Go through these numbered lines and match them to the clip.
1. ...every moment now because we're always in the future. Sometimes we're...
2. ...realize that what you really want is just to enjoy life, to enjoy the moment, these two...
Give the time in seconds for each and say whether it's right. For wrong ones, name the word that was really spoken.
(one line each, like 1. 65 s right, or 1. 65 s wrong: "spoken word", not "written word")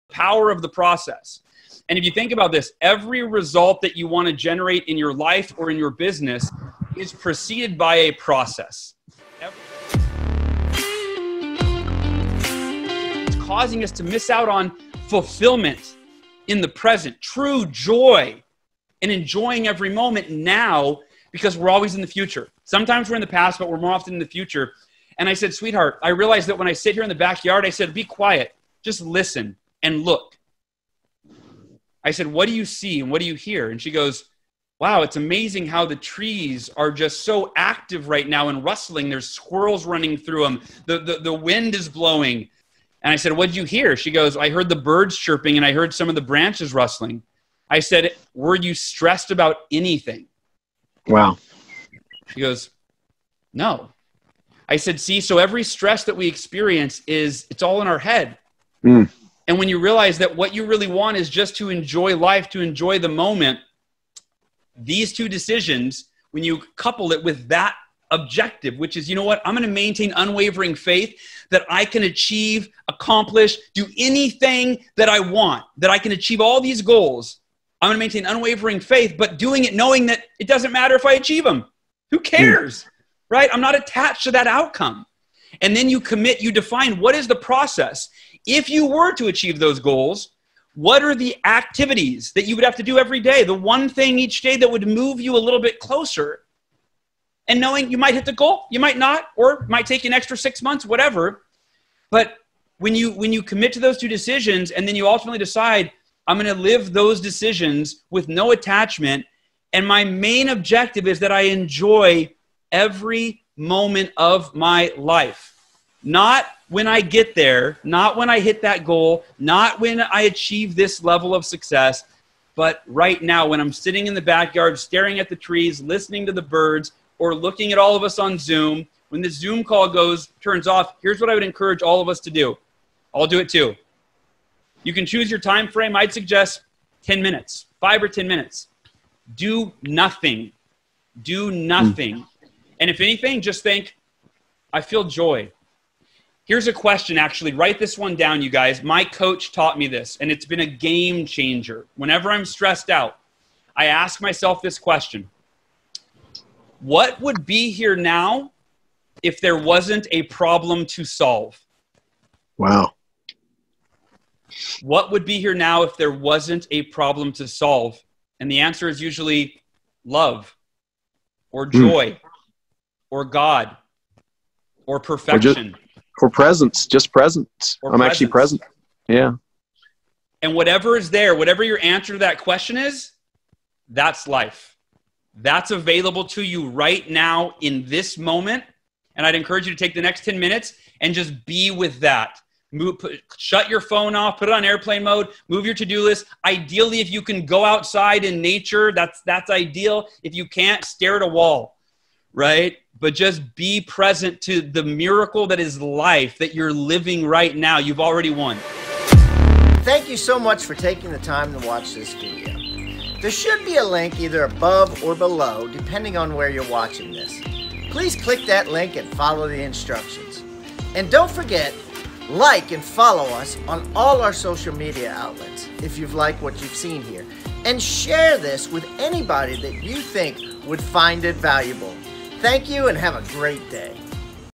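1. 19 s right
2. 59 s right.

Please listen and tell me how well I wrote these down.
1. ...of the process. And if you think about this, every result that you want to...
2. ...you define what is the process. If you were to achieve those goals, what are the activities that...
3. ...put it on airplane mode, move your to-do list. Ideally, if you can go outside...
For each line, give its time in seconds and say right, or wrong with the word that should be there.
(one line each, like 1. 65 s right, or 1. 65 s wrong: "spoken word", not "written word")
1. 0 s right
2. 86 s right
3. 194 s right.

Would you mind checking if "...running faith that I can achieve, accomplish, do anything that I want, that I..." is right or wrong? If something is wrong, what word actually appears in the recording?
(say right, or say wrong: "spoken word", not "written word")
wrong: "unwavering", not "running".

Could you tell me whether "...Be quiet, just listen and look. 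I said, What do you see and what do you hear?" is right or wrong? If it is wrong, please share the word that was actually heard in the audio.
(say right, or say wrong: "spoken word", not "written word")
right.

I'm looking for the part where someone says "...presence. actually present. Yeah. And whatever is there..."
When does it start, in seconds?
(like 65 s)
177 s.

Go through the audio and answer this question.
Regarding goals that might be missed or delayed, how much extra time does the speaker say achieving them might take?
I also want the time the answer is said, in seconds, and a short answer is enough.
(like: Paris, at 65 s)
6 months, at 100 s.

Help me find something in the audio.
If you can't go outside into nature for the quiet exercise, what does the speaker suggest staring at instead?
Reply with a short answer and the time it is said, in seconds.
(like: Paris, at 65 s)
a wall, at 200 s.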